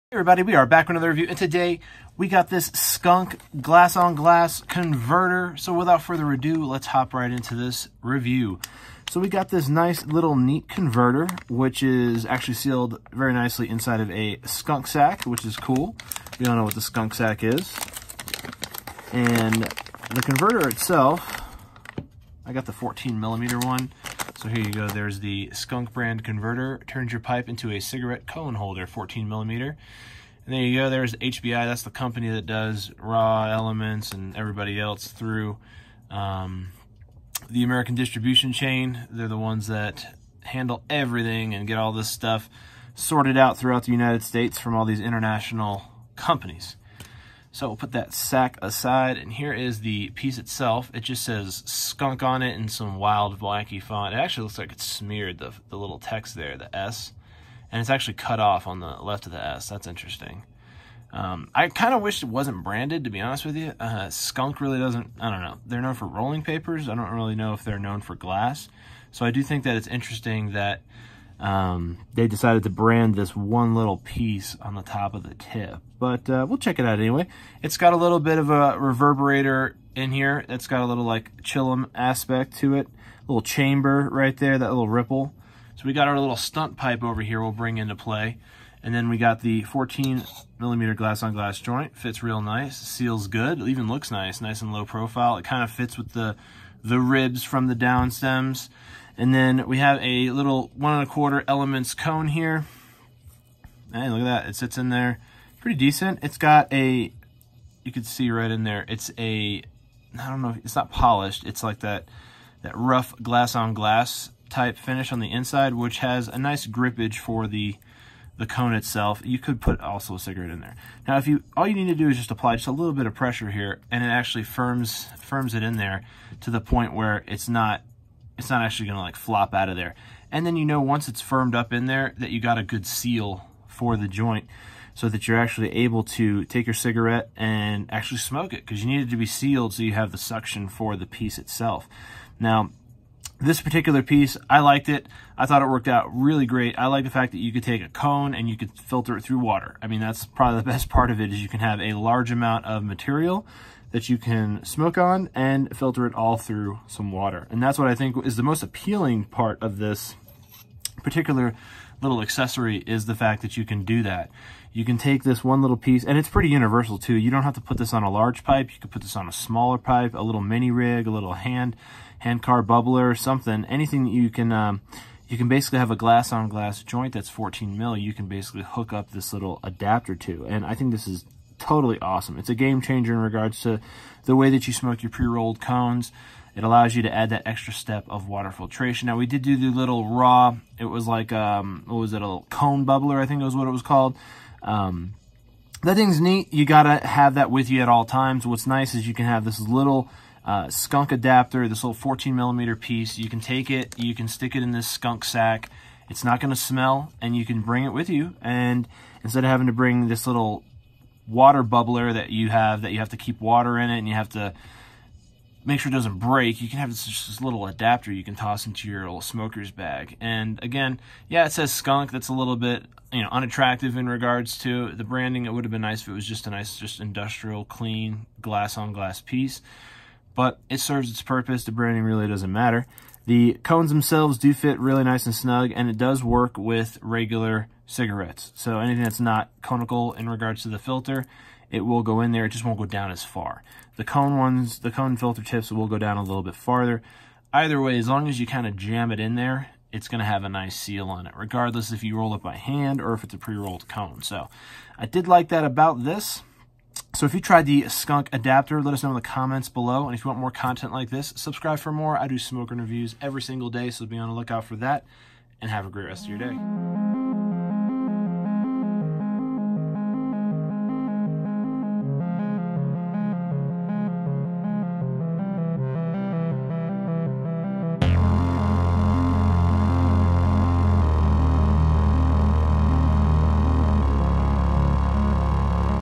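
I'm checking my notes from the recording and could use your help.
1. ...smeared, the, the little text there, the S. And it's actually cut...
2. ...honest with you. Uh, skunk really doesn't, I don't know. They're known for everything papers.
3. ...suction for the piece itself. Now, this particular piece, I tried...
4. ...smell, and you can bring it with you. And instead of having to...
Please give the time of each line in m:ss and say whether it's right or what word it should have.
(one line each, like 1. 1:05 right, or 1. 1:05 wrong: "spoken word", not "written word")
1. 0:54 right
2. 1:03 wrong: "rolling", not "everything"
3. 2:20 wrong: "liked", not "tried"
4. 3:26 right.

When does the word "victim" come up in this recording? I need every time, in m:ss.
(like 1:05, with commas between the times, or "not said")
not said.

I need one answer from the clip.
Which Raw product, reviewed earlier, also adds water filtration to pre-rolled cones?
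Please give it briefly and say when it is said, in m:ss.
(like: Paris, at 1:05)
Cone bubbler, at 3:12.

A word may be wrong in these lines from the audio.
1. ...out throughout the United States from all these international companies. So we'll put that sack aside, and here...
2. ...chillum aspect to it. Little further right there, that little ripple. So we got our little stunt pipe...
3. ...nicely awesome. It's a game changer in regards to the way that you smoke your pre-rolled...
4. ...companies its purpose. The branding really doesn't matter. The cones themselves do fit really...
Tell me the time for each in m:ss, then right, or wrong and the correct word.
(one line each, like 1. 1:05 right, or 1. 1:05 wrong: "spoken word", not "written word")
1. 0:43 right
2. 1:21 wrong: "chamber", not "further"
3. 3:01 wrong: "totally", not "nicely"
4. 3:50 wrong: "serves", not "companies".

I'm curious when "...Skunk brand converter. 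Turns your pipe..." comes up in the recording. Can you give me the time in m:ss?
0:25.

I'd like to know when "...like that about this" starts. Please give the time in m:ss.
4:15.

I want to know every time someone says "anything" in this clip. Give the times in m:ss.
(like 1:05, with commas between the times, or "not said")
2:53, 3:58.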